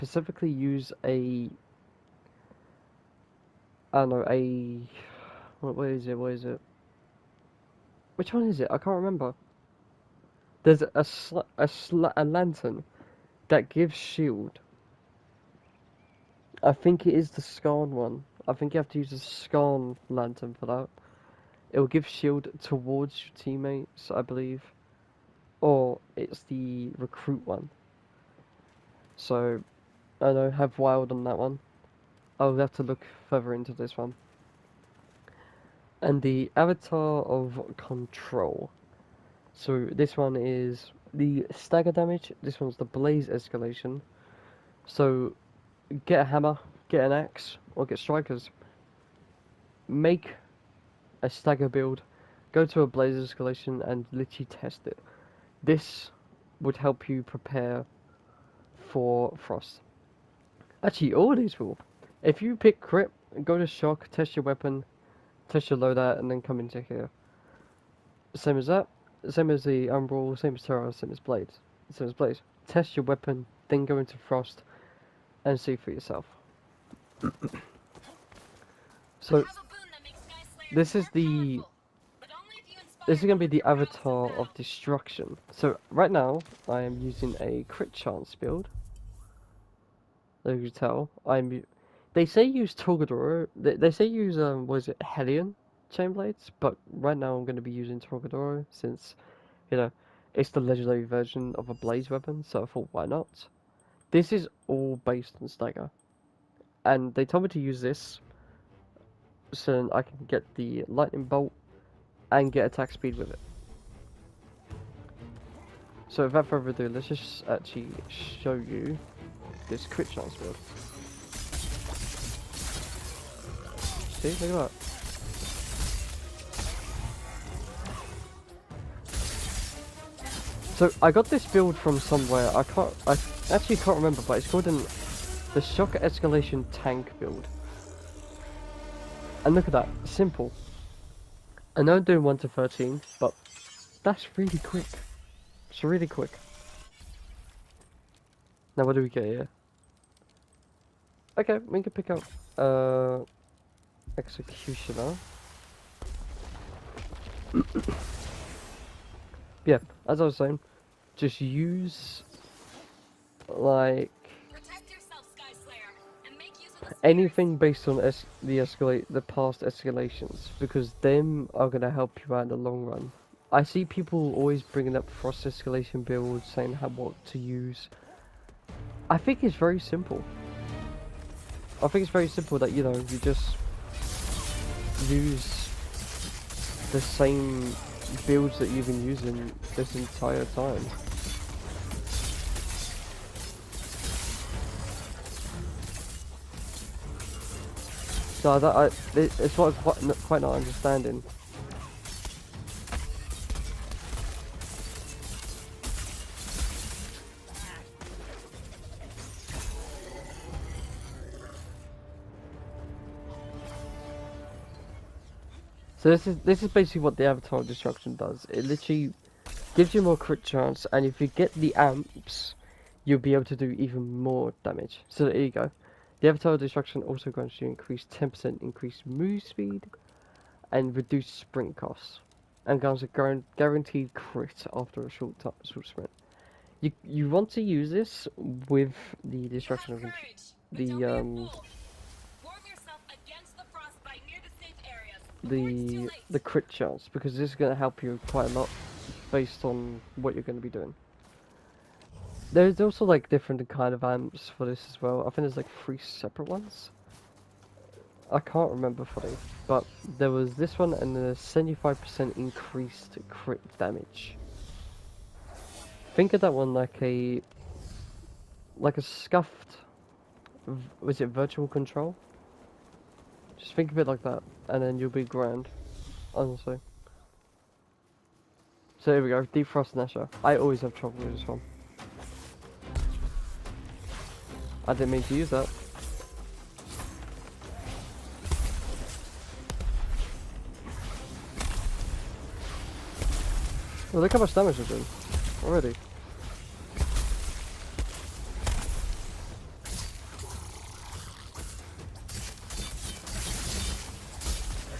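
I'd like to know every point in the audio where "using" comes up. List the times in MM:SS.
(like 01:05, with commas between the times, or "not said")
01:27, 01:37, 03:09.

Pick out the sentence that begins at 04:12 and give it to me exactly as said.
There's also like different kind of amps for this as well.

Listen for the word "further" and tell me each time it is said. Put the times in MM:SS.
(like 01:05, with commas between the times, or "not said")
00:33, 01:56.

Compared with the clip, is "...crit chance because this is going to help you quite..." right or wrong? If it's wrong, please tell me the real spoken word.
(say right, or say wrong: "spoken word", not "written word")
right.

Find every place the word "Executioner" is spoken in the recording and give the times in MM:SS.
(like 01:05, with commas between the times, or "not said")
02:34.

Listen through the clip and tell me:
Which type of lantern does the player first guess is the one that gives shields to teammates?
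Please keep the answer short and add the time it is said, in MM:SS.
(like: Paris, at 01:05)
Skarn lantern, at 00:19.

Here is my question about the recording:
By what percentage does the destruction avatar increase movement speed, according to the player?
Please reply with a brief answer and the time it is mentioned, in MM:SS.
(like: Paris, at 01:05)
10%, at 03:48.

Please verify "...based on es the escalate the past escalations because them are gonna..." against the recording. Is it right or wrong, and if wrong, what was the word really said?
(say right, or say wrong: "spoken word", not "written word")
right.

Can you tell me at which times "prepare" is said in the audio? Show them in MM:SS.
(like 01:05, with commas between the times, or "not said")
00:57.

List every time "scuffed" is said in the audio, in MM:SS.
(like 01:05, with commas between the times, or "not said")
04:29.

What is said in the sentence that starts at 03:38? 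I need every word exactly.
It literally gives you more crit chance, and if you get the amps, you'll be able to do even more damage.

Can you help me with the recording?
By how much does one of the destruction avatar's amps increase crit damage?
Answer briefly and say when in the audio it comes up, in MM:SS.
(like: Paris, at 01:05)
75%, at 04:21.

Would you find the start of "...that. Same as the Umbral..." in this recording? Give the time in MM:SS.
01:08.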